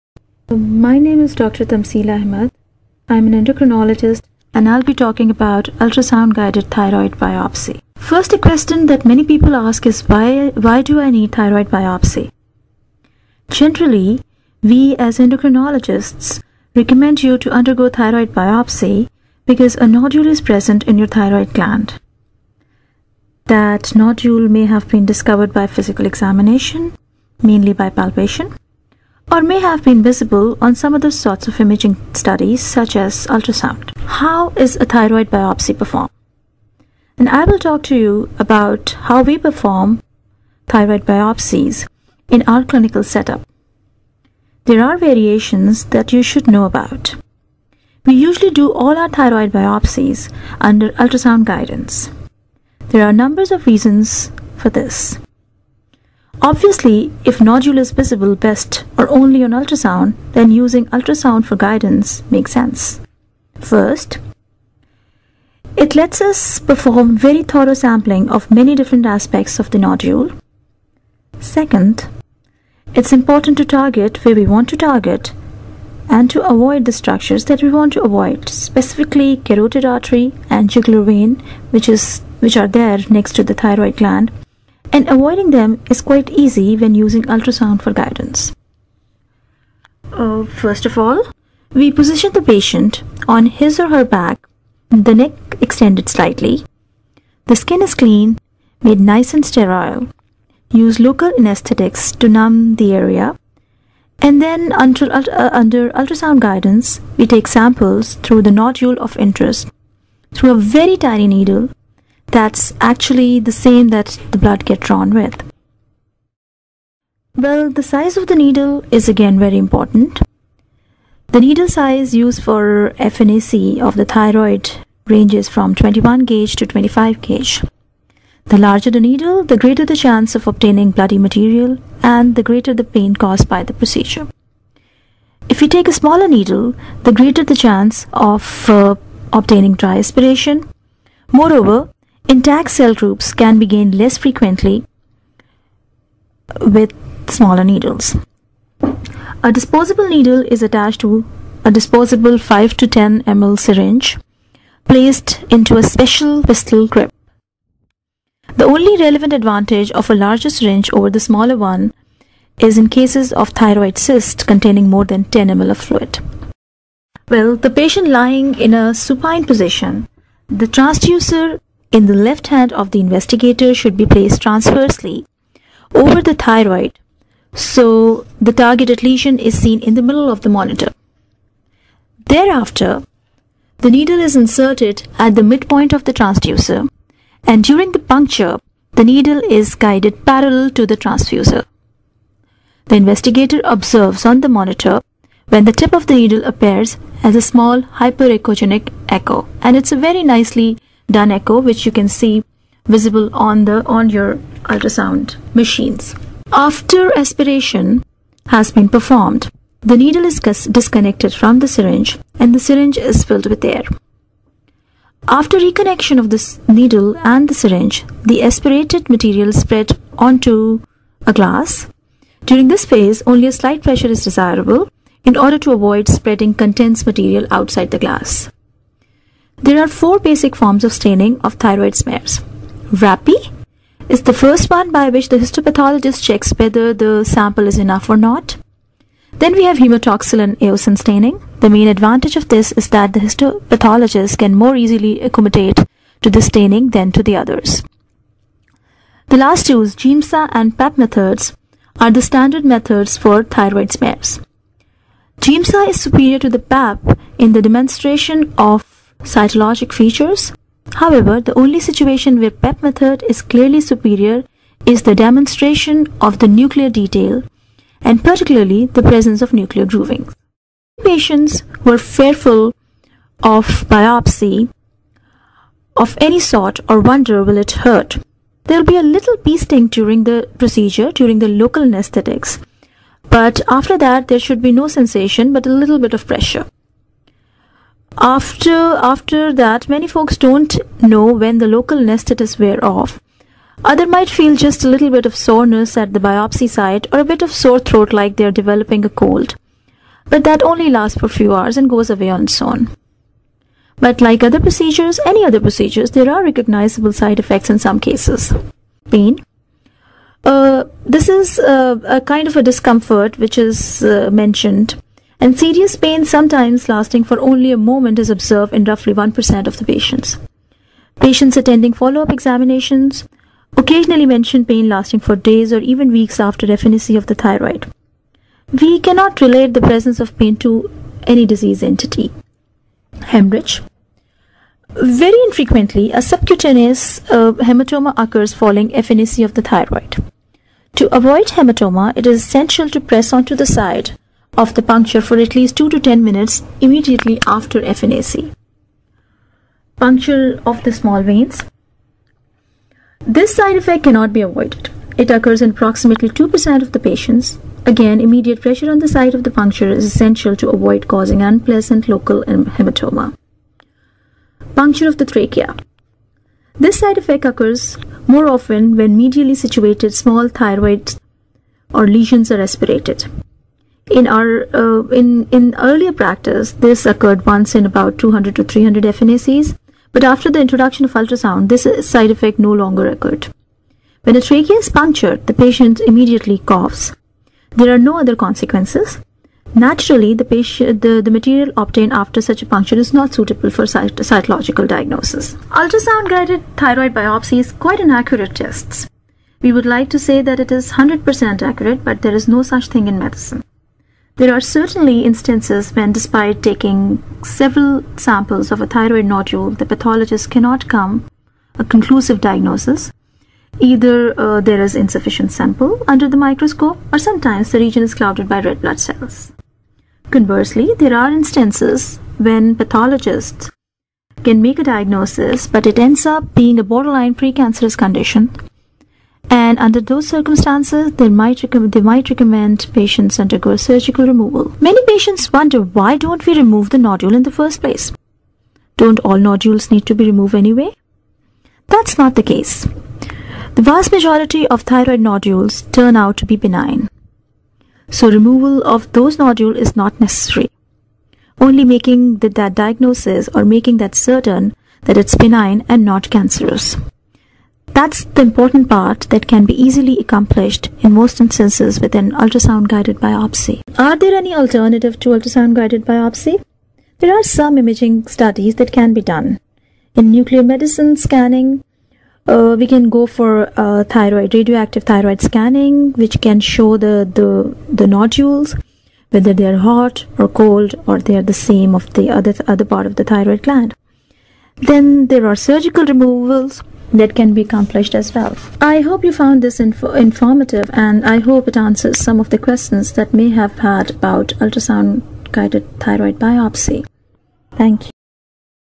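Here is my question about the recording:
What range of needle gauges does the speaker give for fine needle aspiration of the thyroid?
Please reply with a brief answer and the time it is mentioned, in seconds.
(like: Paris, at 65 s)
21 to 25 gauge, at 125 s.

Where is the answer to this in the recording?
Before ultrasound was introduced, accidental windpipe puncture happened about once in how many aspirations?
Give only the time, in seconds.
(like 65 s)
378 s.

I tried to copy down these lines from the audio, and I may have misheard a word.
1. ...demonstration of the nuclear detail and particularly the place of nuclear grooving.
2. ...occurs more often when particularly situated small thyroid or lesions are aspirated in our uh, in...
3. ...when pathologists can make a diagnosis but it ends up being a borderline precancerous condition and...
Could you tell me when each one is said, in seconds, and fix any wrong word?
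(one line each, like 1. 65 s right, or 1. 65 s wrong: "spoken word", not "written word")
1. 265 s wrong: "presence", not "place"
2. 367 s wrong: "medially", not "particularly"
3. 422 s right.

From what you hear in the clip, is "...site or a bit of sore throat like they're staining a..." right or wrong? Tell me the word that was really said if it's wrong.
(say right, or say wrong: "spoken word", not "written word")
wrong: "developing", not "staining".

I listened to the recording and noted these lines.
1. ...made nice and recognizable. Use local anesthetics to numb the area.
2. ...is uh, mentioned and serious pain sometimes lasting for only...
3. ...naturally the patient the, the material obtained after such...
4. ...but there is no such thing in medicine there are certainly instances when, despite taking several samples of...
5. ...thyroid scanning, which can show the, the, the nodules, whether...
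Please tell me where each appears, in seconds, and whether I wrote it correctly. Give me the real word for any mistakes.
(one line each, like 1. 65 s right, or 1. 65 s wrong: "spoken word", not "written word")
1. 98 s wrong: "sterile", not "recognizable"
2. 313 s right
3. 389 s right
4. 402 s right
5. 475 s right.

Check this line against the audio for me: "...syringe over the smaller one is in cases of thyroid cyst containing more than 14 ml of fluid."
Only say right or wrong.
wrong.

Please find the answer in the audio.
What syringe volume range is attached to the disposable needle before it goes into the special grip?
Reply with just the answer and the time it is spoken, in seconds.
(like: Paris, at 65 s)
5 to 10 ml, at 152 s.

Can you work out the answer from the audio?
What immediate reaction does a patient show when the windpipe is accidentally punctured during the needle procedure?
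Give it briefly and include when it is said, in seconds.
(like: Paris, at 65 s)
coughs, at 386 s.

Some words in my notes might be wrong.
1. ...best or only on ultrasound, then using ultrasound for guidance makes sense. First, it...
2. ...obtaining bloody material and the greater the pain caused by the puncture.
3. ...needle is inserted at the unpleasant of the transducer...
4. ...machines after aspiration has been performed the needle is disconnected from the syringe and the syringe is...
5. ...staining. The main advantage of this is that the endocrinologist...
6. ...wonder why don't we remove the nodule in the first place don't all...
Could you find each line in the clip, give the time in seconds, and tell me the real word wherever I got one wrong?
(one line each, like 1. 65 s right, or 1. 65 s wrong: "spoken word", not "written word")
1. 58 s right
2. 130 s wrong: "procedure", not "puncture"
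3. 183 s wrong: "midpoint", not "unpleasant"
4. 205 s right
5. 240 s wrong: "histopathologist", not "endocrinologist"
6. 435 s right.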